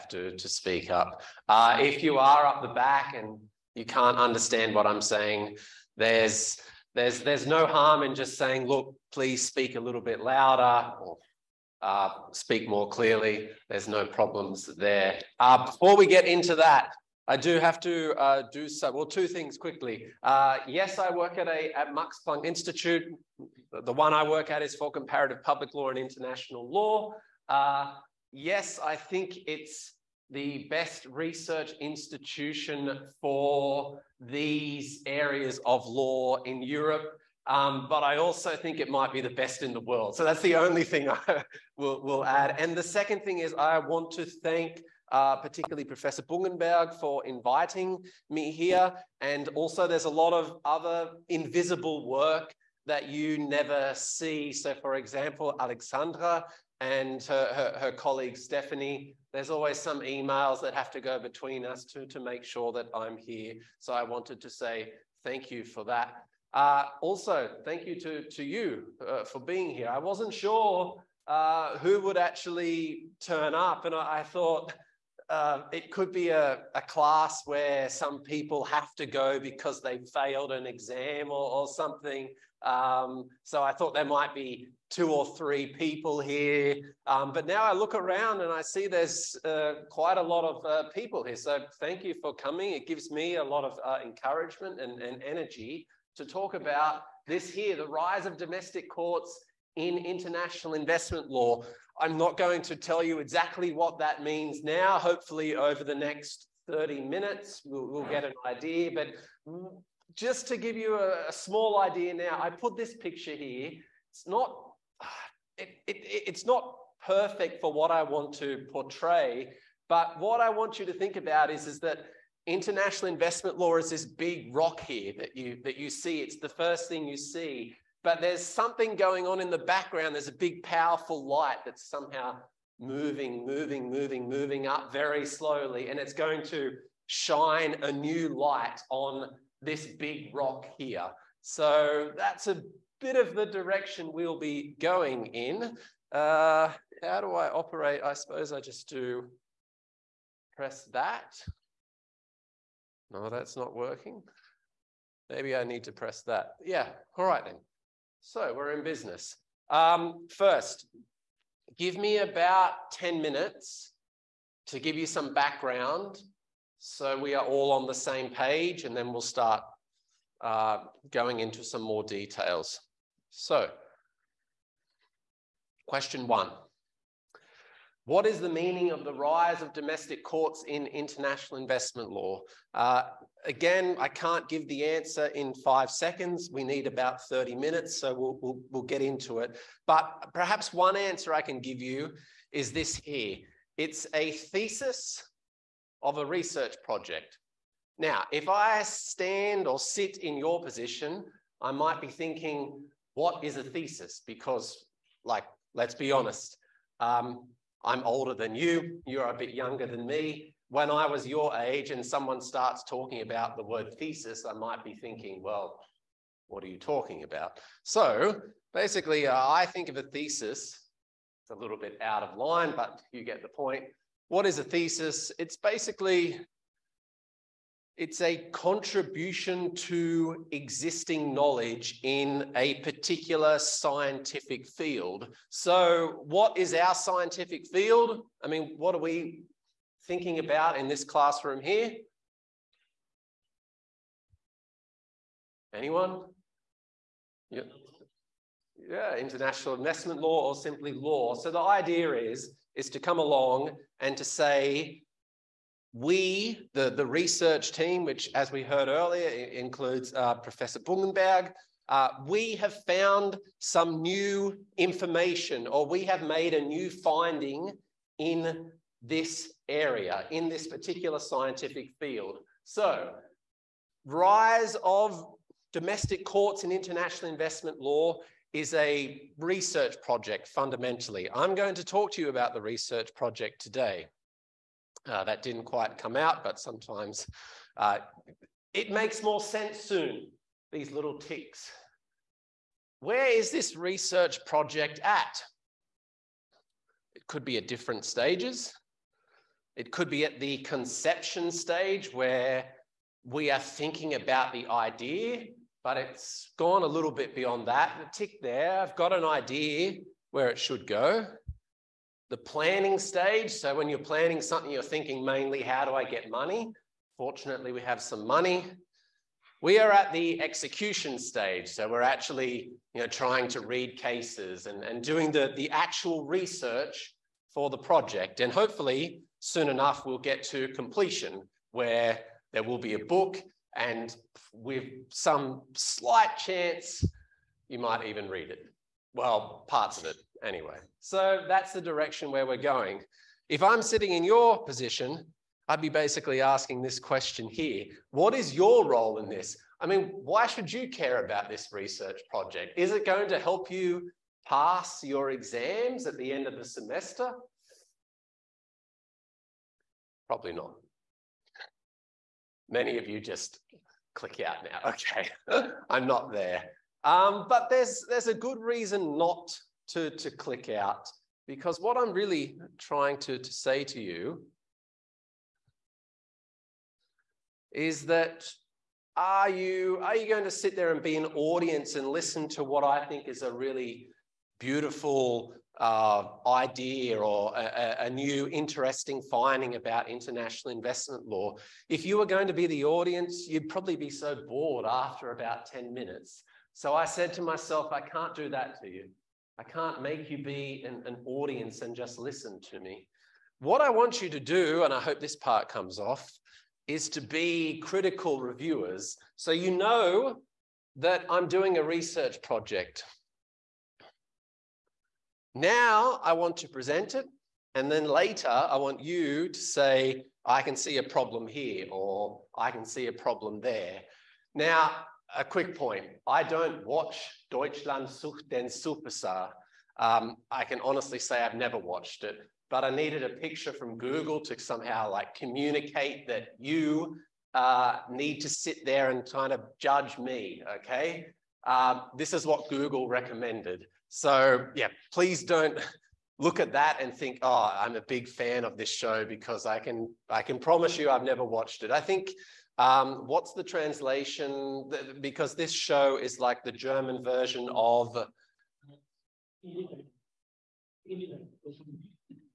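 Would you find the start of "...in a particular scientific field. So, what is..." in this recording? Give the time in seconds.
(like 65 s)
232 s.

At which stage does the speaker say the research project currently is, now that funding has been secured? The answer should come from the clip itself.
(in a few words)
Execution stage.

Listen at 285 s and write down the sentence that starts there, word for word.
Uh, that didn't quite come out, but sometimes uh, it makes more sense soon, these little ticks.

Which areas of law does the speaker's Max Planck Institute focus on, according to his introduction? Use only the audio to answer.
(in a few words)
Comparative public law and international law.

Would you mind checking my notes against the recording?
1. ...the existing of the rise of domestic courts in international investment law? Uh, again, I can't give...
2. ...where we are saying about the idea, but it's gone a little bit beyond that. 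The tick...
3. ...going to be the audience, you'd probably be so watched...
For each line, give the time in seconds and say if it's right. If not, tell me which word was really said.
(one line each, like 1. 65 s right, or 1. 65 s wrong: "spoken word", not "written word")
1. 178 s wrong: "meaning", not "existing"
2. 302 s wrong: "thinking", not "saying"
3. 392 s wrong: "bored", not "watched".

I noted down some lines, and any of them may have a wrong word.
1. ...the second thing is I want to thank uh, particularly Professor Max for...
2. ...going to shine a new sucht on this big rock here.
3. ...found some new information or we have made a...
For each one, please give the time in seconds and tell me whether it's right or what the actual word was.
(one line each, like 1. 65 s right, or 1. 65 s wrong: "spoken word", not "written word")
1. 42 s wrong: "Bungenberg", not "Max"
2. 136 s wrong: "light", not "sucht"
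3. 262 s right.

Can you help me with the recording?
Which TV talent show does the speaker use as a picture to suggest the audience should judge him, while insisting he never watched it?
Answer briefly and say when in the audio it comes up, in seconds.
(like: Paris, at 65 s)
Deutschland sucht den Superstar, at 427 s.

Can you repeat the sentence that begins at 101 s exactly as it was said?
I'm not going to tell you exactly what that means now.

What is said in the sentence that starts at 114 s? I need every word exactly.
It's not, it, it, it's not perfect for what I want to portray.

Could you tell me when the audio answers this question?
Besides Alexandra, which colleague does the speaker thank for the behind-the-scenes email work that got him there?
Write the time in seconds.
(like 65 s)
58 s.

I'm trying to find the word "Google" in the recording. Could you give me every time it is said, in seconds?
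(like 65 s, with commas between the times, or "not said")
433 s, 442 s.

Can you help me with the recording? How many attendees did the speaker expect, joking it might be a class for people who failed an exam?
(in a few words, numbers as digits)
2 or 3.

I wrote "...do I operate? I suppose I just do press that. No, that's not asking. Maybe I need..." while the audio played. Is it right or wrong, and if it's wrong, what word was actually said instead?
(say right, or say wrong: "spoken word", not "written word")
wrong: "working", not "asking".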